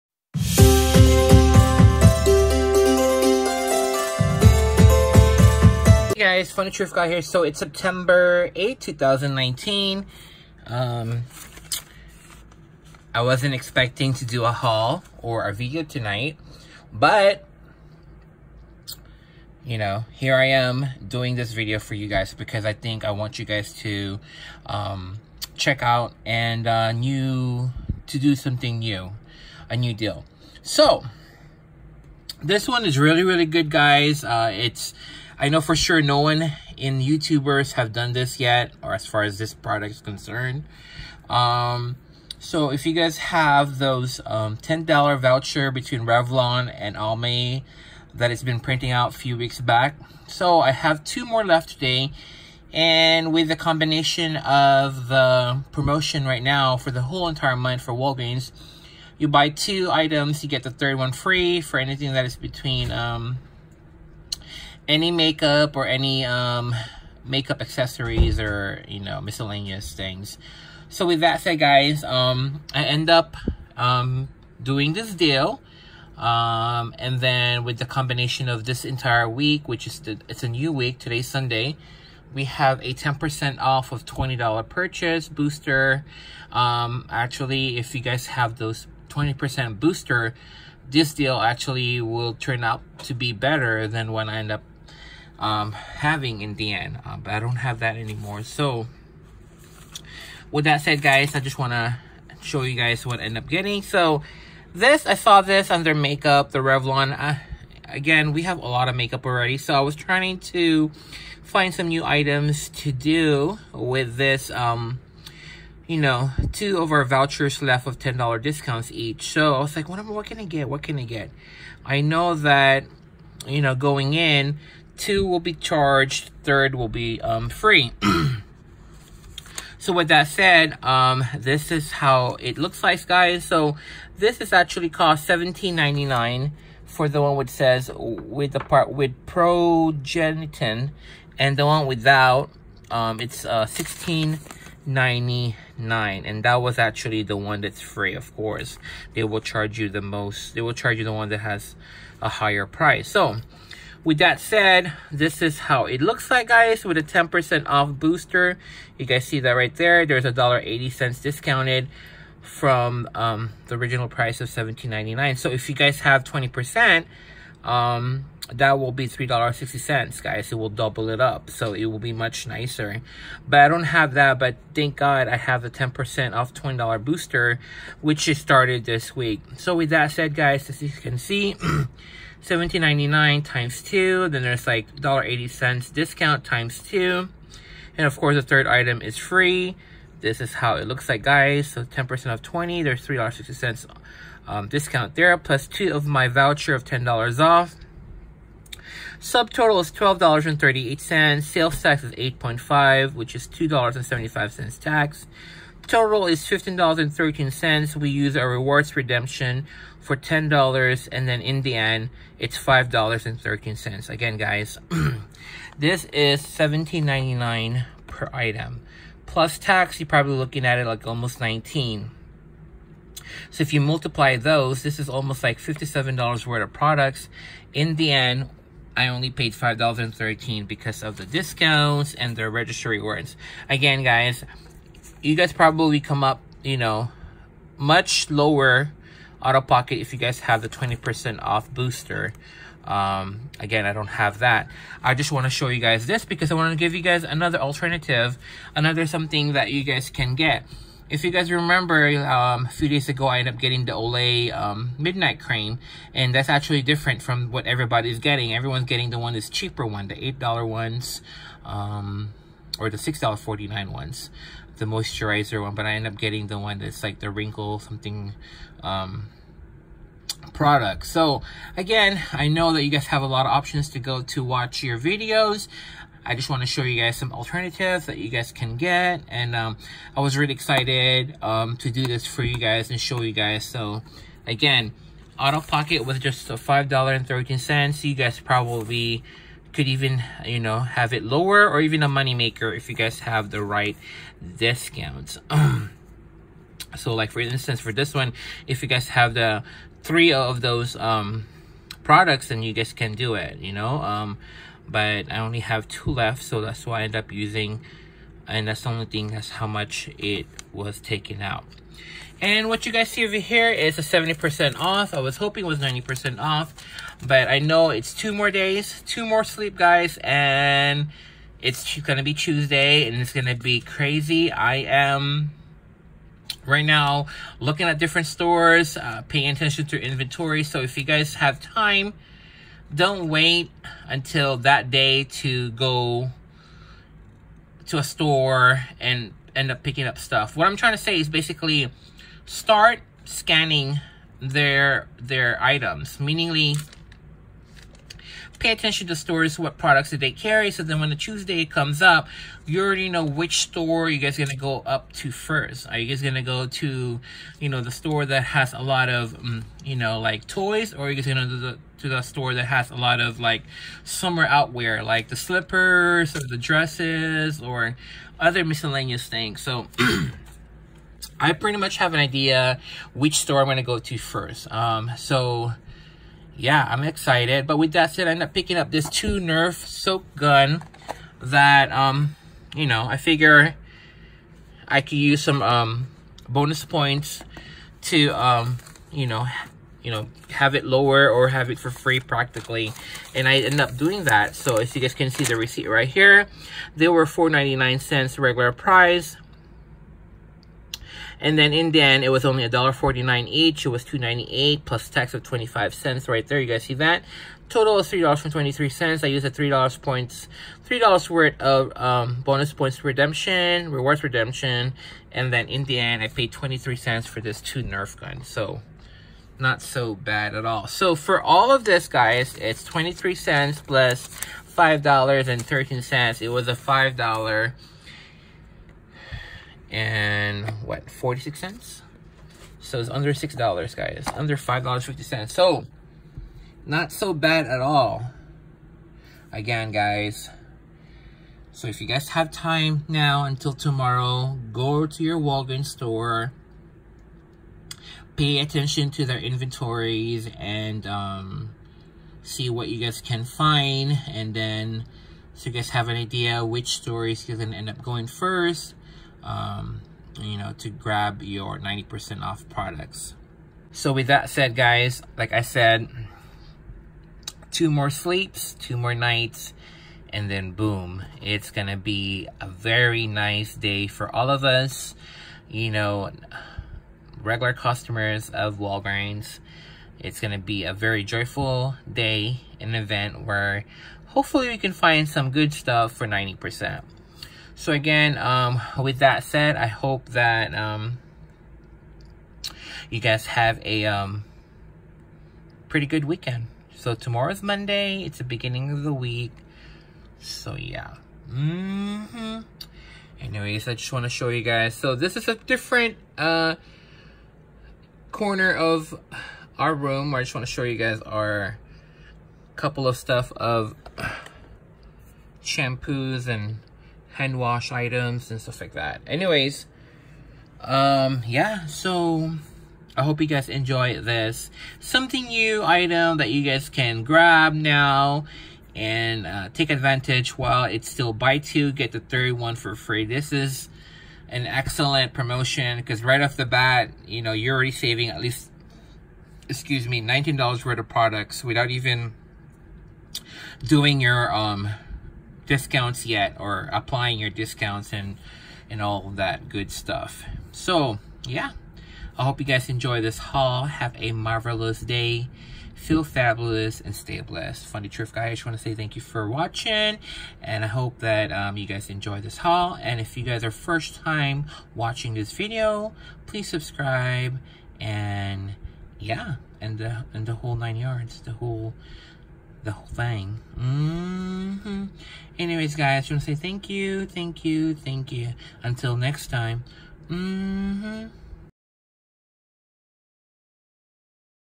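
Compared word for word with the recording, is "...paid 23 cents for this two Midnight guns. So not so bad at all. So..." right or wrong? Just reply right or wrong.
wrong.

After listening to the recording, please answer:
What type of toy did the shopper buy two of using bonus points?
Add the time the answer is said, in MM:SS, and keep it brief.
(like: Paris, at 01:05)
Nerf soap gun, at 06:19.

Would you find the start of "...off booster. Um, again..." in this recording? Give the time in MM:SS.
04:01.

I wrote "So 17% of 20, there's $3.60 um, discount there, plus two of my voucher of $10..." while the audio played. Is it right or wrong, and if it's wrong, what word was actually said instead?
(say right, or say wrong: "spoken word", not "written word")
wrong: "10", not "17".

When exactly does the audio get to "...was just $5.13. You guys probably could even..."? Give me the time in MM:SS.
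04:46.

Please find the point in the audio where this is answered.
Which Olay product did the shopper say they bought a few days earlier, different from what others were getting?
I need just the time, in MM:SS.
04:14.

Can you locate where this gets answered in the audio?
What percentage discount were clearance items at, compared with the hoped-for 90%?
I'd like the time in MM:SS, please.
05:14.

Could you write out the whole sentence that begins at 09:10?
So yeah, I hope you guys enjoy this haul.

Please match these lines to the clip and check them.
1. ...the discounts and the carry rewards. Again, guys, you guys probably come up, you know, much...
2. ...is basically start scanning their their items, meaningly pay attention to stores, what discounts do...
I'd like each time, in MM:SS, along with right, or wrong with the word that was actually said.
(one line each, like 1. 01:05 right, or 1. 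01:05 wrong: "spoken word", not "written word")
1. 03:51 wrong: "registry", not "carry"
2. 05:41 wrong: "products", not "discounts".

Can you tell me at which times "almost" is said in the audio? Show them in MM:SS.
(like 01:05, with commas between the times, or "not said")
03:41, 03:45.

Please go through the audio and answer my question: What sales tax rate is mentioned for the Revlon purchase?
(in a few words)
8.5.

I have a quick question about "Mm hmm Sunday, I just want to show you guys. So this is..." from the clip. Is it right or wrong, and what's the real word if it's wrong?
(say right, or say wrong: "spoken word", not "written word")
wrong: "Anyways", not "Sunday".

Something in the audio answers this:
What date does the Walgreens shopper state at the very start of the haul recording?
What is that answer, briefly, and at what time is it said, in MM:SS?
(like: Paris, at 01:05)
September 8, 2019, at 00:07.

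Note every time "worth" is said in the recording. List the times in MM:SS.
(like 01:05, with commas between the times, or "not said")
03:46, 06:51, 09:00.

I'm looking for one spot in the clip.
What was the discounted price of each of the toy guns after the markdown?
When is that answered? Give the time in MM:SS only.
06:42.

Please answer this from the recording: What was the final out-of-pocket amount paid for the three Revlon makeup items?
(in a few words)
$5.13.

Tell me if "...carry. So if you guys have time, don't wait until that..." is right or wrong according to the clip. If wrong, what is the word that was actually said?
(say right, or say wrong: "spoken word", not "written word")
wrong: "inventory", not "carry".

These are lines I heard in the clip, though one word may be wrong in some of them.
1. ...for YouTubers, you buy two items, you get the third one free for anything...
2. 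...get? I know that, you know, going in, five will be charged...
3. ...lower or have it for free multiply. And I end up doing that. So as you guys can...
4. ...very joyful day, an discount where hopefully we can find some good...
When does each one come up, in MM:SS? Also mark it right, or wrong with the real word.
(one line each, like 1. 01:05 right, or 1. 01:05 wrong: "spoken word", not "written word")
1. 00:57 wrong: "Walgreens", not "YouTubers"
2. 02:01 wrong: "two", not "five"
3. 06:30 wrong: "practically", not "multiply"
4. 08:00 wrong: "event", not "discount".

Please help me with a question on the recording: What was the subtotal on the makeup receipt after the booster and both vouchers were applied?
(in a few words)
$12.38.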